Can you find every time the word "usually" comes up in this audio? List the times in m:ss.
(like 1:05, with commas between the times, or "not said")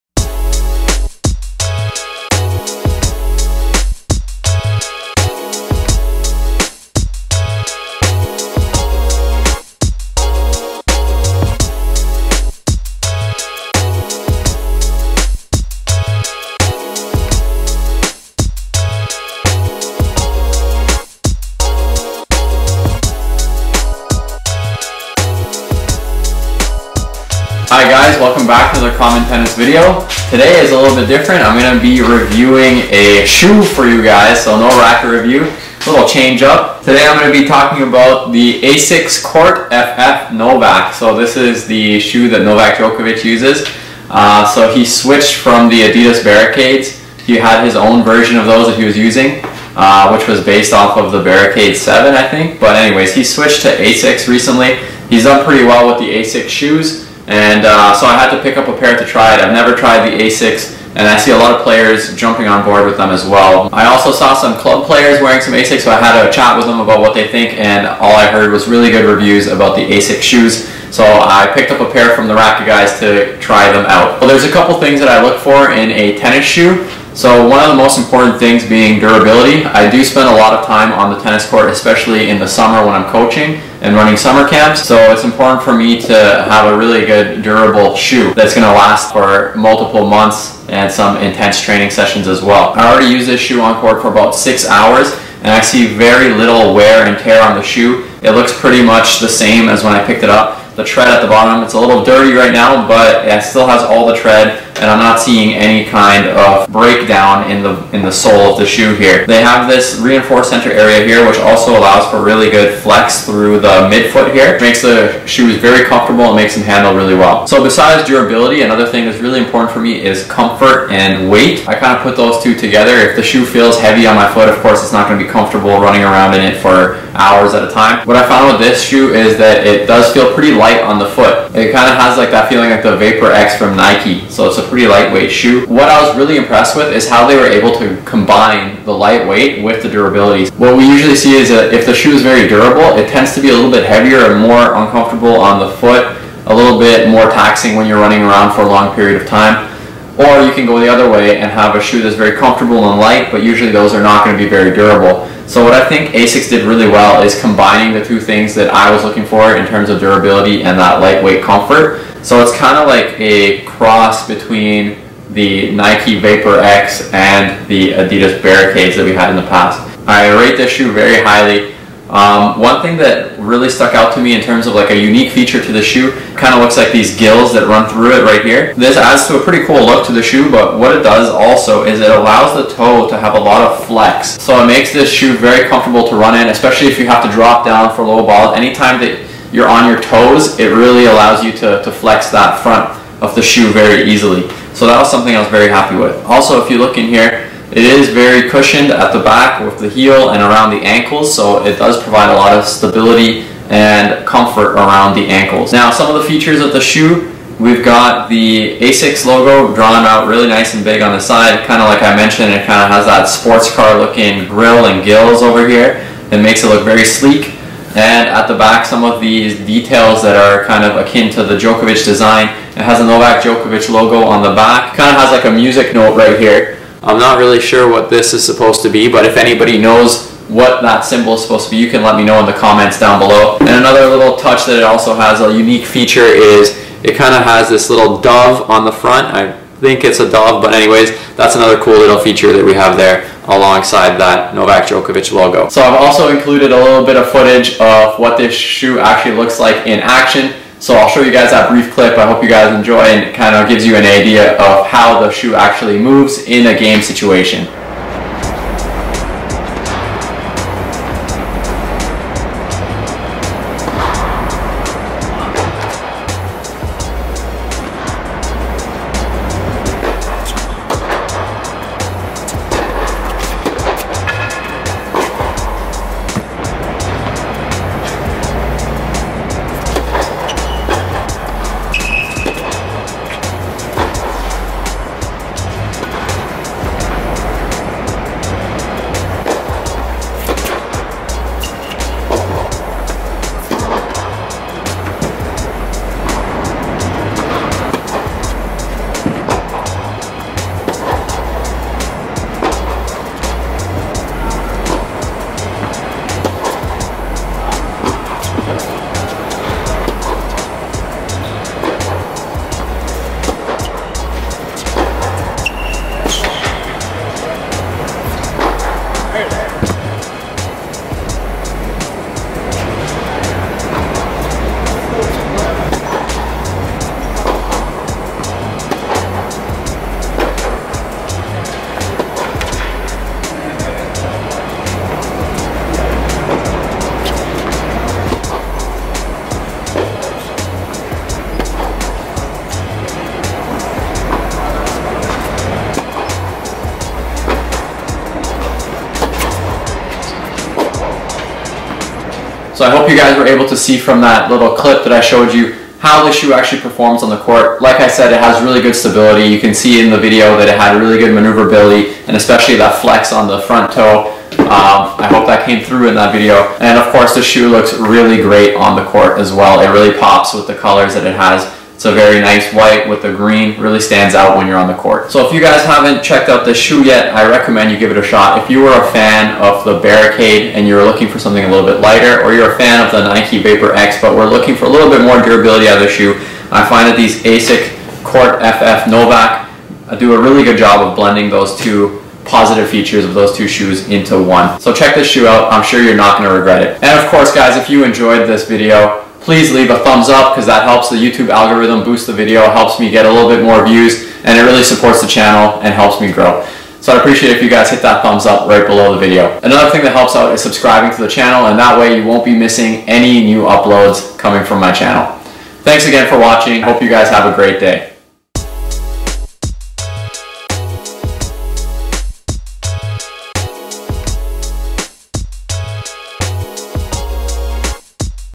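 2:20, 2:33.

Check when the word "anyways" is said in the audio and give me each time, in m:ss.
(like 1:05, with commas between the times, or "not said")
0:52, 4:00.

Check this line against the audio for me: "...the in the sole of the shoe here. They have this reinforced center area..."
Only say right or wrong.
right.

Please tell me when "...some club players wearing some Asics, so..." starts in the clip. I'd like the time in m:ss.
1:04.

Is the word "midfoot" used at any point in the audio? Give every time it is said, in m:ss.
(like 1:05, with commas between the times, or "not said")
1:53.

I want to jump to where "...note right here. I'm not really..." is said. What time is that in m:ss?
3:45.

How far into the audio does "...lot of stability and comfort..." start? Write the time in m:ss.
3:22.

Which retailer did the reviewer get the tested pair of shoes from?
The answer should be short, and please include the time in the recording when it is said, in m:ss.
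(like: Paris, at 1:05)
the Racquet Guys, at 1:12.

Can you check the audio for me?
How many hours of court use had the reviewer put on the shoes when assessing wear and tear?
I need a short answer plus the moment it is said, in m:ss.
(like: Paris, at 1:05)
6, at 1:34.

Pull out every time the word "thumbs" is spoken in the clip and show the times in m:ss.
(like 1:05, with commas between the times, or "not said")
6:39, 6:48.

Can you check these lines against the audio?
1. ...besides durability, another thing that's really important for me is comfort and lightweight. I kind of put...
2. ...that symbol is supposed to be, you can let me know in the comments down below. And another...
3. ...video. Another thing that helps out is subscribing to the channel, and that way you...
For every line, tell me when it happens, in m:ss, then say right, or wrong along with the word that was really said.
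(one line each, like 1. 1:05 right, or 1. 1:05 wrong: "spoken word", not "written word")
1. 1:57 wrong: "weight", not "lightweight"
2. 3:50 right
3. 6:49 right.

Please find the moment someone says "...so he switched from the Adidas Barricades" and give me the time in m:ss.
0:44.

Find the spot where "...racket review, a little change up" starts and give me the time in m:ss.
0:34.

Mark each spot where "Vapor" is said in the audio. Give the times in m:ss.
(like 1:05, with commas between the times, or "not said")
2:12, 2:46, 6:23.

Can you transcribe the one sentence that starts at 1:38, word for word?
It looks pretty much the same as when I picked it up.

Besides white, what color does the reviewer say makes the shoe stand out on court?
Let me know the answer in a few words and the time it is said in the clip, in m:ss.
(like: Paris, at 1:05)
green, at 6:13.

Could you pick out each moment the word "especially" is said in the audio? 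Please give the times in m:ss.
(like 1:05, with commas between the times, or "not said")
1:21, 3:06, 6:02.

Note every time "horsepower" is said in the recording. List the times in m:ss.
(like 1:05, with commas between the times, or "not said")
not said.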